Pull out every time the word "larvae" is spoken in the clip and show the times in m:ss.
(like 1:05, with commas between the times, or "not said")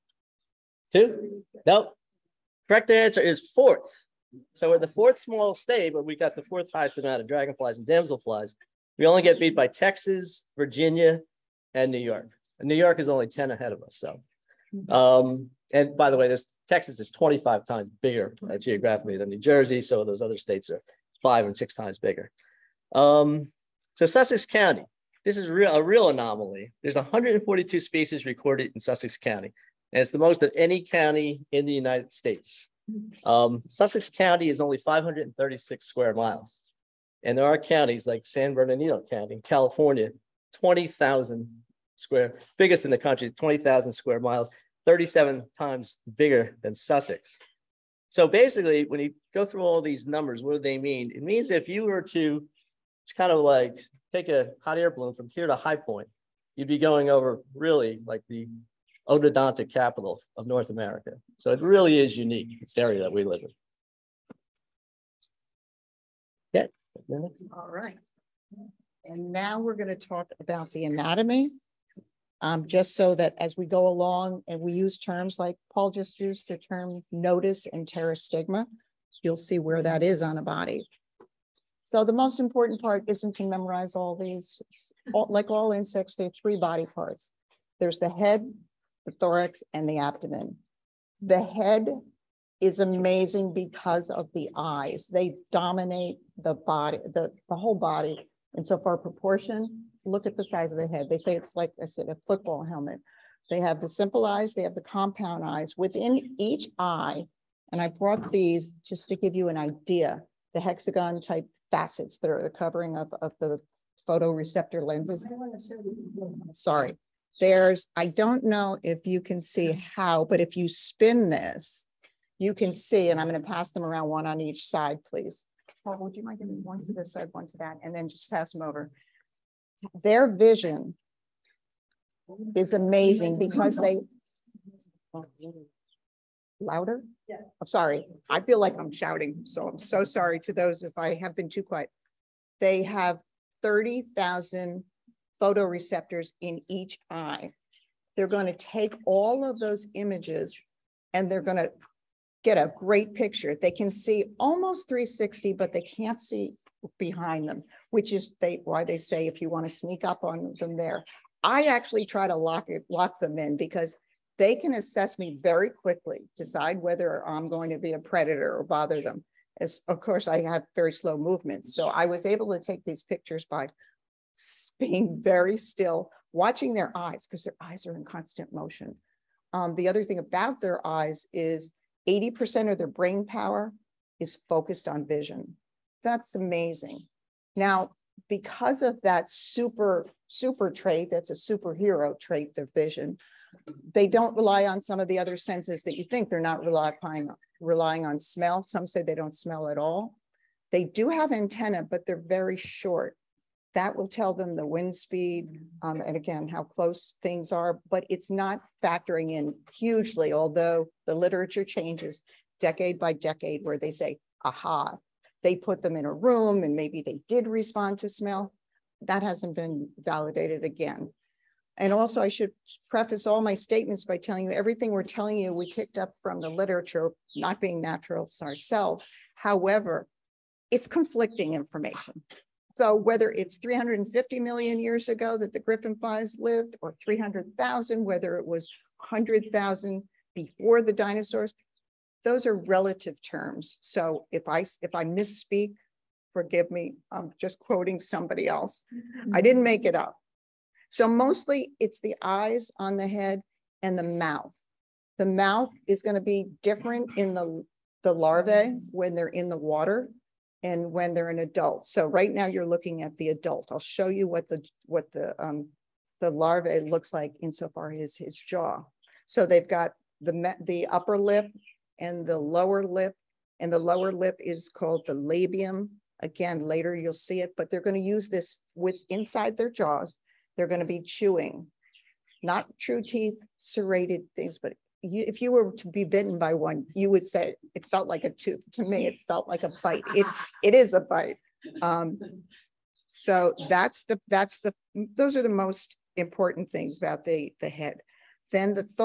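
4:18, 4:26.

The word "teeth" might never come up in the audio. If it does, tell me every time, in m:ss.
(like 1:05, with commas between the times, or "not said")
4:43.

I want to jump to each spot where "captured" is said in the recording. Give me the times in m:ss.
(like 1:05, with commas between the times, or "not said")
not said.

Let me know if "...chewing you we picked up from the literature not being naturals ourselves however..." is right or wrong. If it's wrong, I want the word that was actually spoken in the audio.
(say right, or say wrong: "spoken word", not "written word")
wrong: "telling", not "chewing".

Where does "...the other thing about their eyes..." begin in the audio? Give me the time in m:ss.
2:59.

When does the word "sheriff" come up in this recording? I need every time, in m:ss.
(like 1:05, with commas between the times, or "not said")
not said.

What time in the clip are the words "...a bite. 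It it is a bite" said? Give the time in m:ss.
4:49.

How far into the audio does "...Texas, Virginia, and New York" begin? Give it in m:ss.
0:09.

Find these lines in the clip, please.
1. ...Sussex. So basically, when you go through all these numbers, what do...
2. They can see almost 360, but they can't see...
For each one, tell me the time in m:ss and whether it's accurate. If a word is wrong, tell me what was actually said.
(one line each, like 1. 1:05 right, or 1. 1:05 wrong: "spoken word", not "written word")
1. 0:46 right
2. 2:33 right.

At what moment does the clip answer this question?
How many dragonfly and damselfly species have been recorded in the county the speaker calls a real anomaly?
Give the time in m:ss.
0:26.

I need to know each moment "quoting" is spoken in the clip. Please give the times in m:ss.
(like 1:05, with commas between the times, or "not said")
4:07.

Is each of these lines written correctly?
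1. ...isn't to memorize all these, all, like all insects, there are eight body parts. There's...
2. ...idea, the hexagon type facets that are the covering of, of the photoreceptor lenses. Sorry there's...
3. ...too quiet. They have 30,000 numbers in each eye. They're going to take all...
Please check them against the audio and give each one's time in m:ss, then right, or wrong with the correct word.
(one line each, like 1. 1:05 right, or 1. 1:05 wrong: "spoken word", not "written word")
1. 1:23 wrong: "three", not "eight"
2. 1:49 right
3. 2:21 wrong: "photoreceptors", not "numbers".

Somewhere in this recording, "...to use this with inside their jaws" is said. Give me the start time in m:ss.
4:37.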